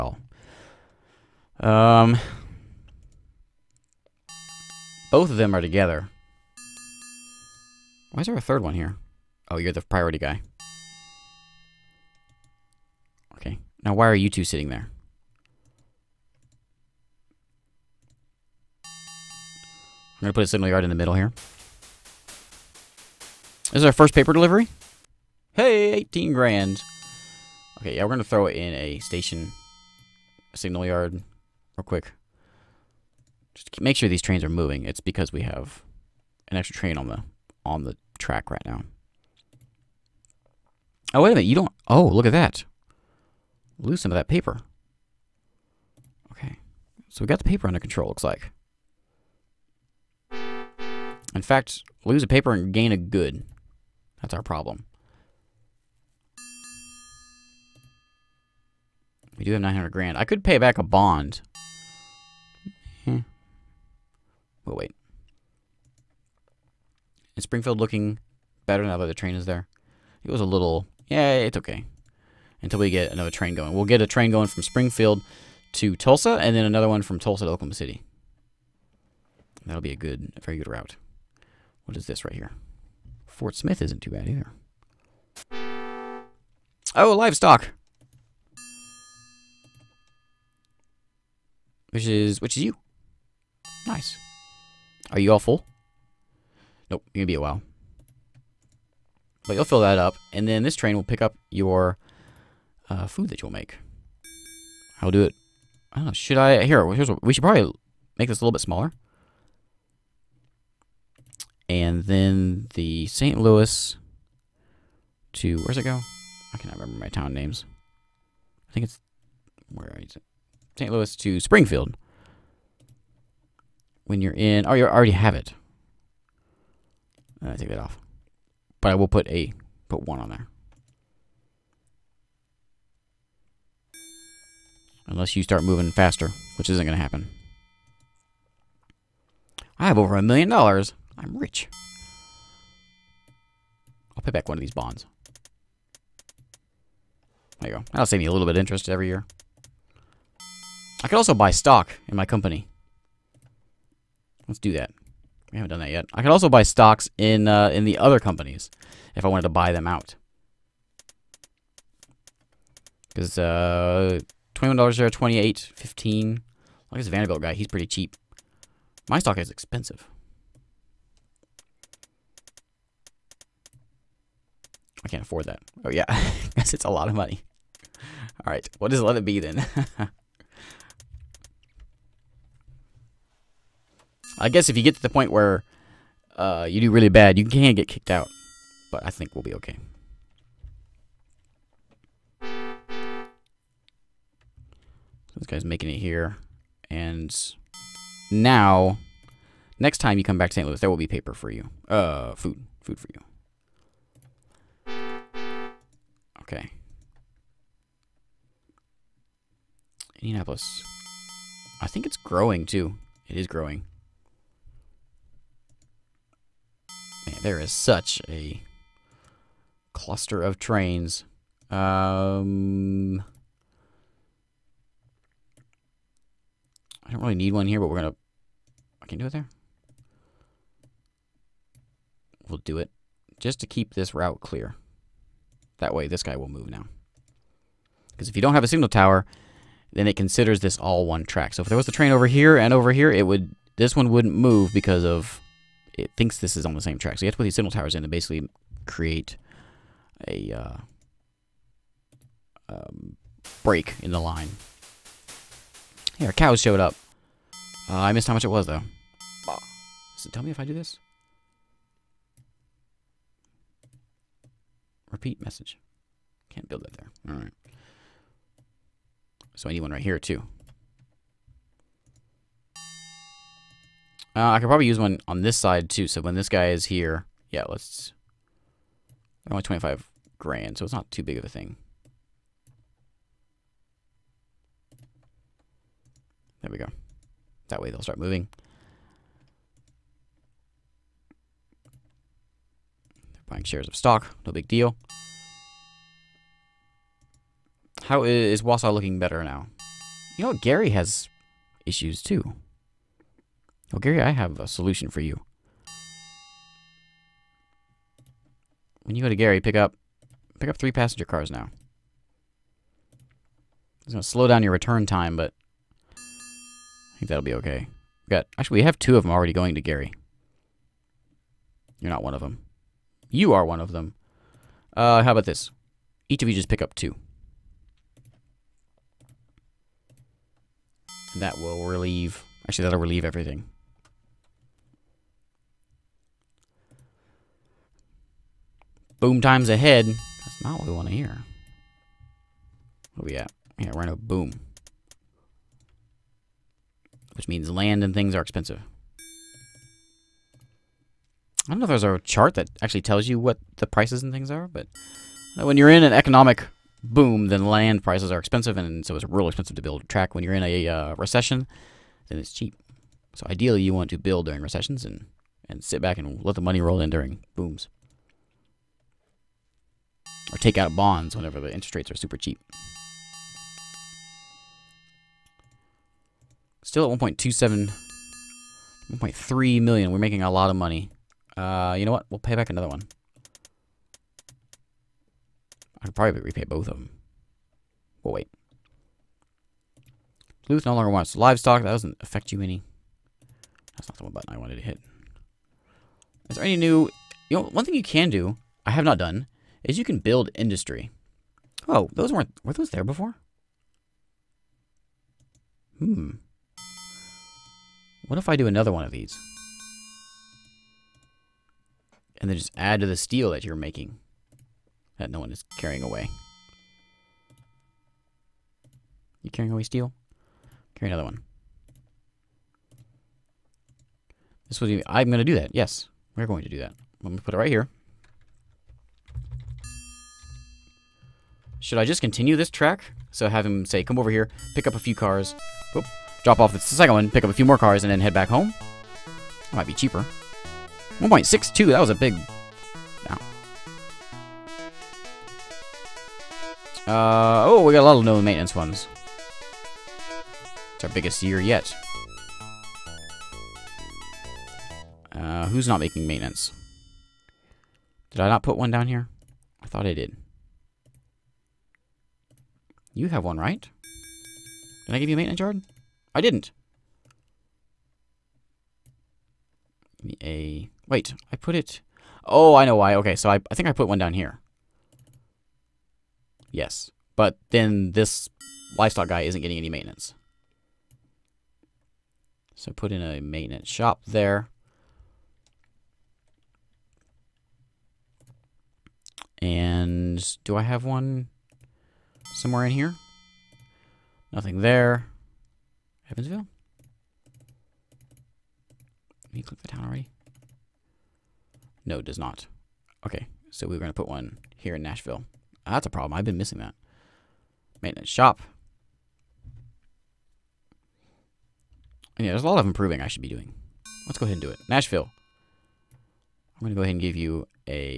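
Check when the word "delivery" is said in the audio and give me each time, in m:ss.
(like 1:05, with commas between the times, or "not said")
0:24.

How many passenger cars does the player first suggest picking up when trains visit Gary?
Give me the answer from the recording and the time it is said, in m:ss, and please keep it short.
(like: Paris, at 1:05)
3, at 5:10.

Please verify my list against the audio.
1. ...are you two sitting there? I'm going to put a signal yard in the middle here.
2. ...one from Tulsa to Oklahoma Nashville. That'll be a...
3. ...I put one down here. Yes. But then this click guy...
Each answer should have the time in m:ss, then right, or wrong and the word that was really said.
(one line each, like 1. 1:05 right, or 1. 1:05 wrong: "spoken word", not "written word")
1. 0:14 right
2. 1:16 wrong: "City", not "Nashville"
3. 7:53 wrong: "livestock", not "click".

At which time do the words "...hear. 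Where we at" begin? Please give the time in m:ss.
5:41.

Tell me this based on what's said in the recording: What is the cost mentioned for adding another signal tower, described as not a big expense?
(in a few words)
25 grand.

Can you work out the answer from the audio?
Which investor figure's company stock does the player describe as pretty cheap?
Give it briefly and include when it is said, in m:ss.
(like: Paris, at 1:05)
Vanderbilt, at 2:47.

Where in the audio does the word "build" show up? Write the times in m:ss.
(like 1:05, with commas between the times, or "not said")
4:26, 5:59, 6:04, 6:40.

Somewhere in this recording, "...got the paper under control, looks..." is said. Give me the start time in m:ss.
0:47.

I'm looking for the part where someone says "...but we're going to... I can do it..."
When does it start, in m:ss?
3:47.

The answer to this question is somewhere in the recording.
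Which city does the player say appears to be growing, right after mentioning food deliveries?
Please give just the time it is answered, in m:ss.
3:30.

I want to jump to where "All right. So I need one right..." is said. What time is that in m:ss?
4:27.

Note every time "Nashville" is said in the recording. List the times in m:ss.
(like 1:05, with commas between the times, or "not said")
8:25, 8:34.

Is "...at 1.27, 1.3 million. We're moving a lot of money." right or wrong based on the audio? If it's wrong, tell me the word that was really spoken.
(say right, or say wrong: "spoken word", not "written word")
wrong: "making", not "moving".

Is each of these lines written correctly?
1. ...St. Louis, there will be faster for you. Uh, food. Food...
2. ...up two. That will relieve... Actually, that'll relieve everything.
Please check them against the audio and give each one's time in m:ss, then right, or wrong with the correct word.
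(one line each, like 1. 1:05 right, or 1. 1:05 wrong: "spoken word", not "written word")
1. 3:20 wrong: "paper", not "faster"
2. 5:26 right.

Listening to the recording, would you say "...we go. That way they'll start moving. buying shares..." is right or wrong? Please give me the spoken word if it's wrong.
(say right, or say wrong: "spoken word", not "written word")
right.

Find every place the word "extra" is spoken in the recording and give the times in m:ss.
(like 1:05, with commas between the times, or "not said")
0:36.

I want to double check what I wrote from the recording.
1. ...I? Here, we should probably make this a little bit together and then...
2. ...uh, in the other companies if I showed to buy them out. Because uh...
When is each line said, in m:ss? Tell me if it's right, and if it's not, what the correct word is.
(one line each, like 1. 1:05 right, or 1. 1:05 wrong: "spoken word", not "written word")
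1. 1:46 wrong: "smaller", not "together"
2. 2:37 wrong: "wanted", not "showed".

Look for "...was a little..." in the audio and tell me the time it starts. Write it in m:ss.
1:10.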